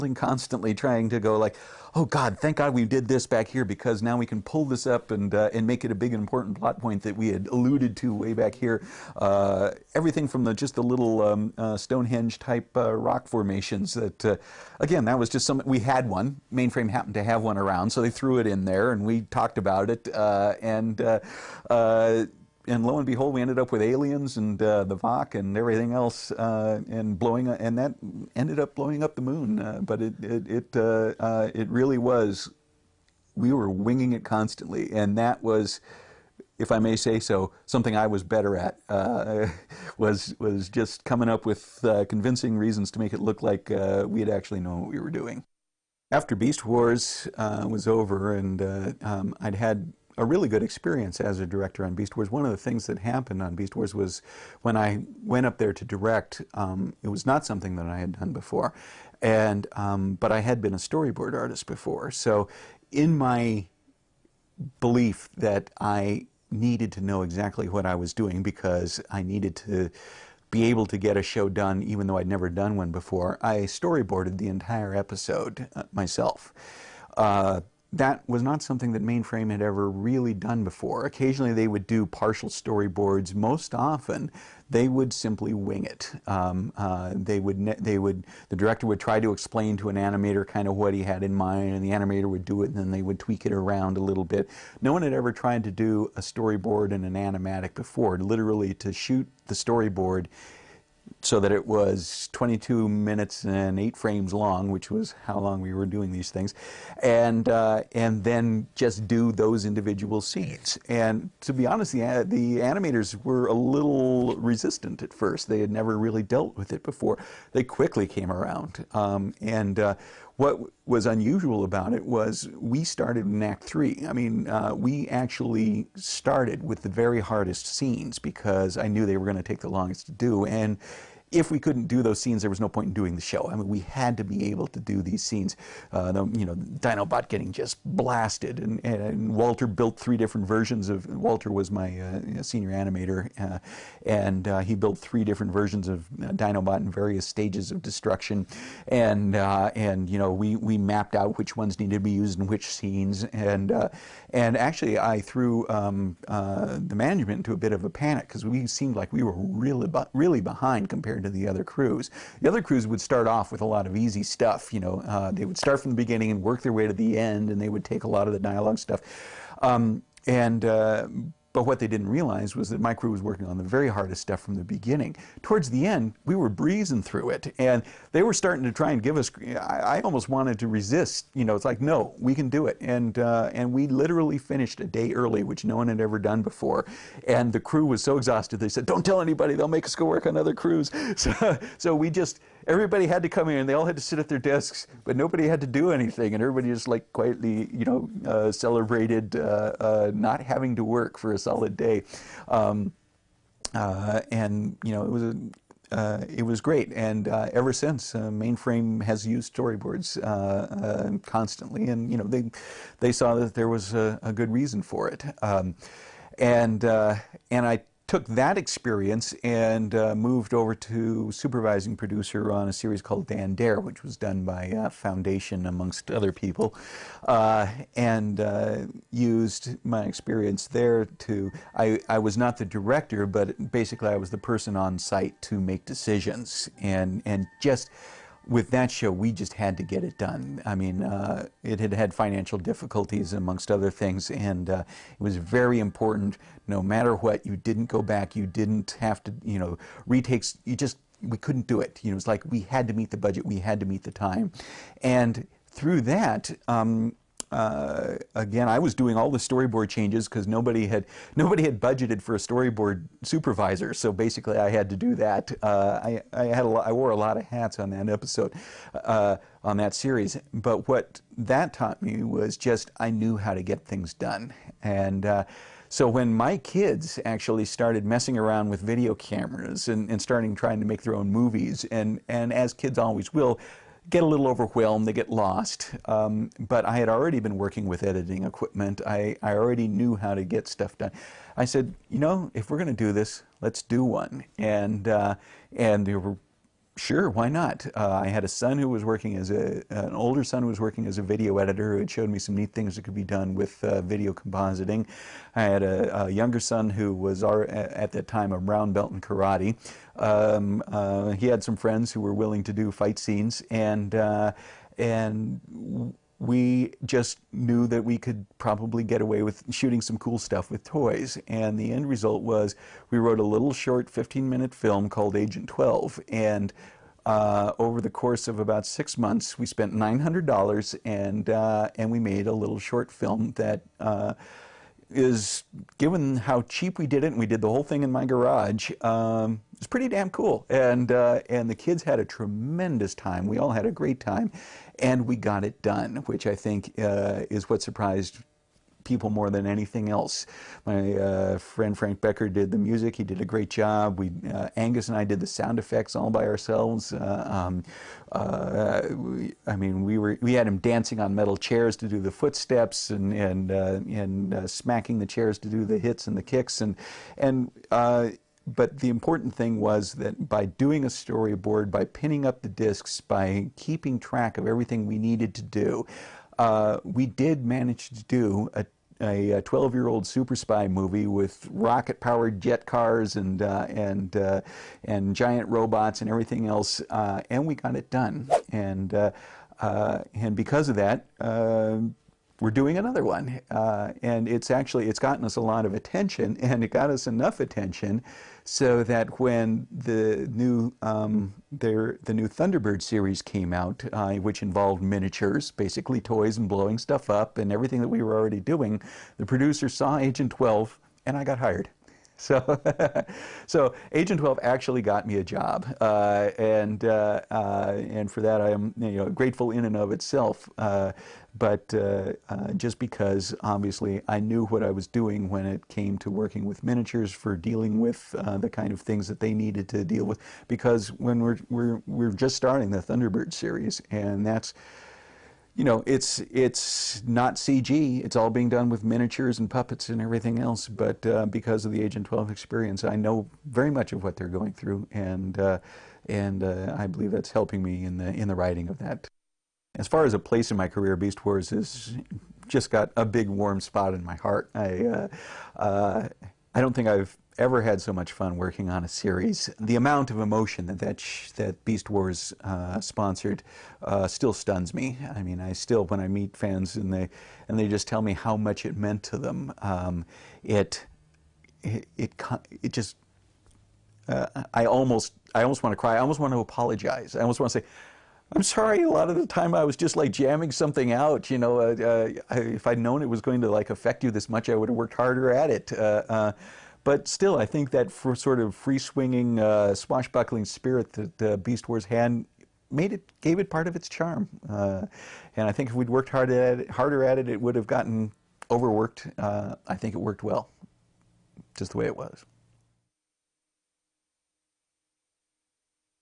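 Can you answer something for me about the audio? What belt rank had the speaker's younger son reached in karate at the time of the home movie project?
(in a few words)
brown belt.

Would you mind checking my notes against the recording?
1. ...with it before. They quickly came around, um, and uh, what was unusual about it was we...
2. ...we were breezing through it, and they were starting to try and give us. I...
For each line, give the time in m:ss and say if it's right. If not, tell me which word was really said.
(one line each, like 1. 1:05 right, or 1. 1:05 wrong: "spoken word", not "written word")
1. 1:56 right
2. 2:56 right.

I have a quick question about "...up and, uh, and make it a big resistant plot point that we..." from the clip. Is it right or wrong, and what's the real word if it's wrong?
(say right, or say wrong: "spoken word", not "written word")
wrong: "important", not "resistant".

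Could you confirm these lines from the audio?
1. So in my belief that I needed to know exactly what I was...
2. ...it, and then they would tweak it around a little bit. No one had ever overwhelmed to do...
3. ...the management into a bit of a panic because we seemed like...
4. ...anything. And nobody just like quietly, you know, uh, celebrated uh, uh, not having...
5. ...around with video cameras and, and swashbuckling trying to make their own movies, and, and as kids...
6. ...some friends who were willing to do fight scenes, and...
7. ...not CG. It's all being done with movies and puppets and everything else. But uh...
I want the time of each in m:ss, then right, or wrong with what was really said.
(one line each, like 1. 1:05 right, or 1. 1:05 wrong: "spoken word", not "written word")
1. 1:02 right
2. 1:32 wrong: "tried", not "overwhelmed"
3. 2:36 right
4. 3:15 wrong: "everybody", not "nobody"
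5. 4:38 wrong: "starting", not "swashbuckling"
6. 5:11 right
7. 7:17 wrong: "miniatures", not "movies".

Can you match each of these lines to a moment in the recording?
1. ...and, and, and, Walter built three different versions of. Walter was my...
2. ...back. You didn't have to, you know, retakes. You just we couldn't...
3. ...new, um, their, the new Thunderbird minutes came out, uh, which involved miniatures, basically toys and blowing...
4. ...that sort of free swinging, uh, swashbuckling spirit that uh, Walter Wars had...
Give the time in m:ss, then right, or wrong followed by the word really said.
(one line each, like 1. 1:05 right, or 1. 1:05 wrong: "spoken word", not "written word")
1. 2:18 right
2. 4:08 right
3. 6:40 wrong: "series", not "minutes"
4. 8:07 wrong: "Beast", not "Walter".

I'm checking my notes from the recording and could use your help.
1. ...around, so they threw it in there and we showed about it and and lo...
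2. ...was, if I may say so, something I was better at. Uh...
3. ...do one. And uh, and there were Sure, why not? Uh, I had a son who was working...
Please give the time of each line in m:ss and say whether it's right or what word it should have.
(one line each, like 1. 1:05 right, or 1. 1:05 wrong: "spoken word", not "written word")
1. 0:17 wrong: "talked", not "showed"
2. 0:35 right
3. 4:53 right.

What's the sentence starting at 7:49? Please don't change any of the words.
Um, it, it it it just uh, I almost I almost want to cry.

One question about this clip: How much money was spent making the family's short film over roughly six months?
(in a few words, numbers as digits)
$900.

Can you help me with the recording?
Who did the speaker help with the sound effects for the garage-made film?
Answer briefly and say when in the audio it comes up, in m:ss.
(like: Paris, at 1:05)
Angus, at 5:54.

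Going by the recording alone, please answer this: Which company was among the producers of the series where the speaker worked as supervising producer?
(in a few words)
Foundation.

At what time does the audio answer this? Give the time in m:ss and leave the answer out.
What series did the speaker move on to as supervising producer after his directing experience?
3:43.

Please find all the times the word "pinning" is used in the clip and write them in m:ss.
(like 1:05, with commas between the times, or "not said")
6:12.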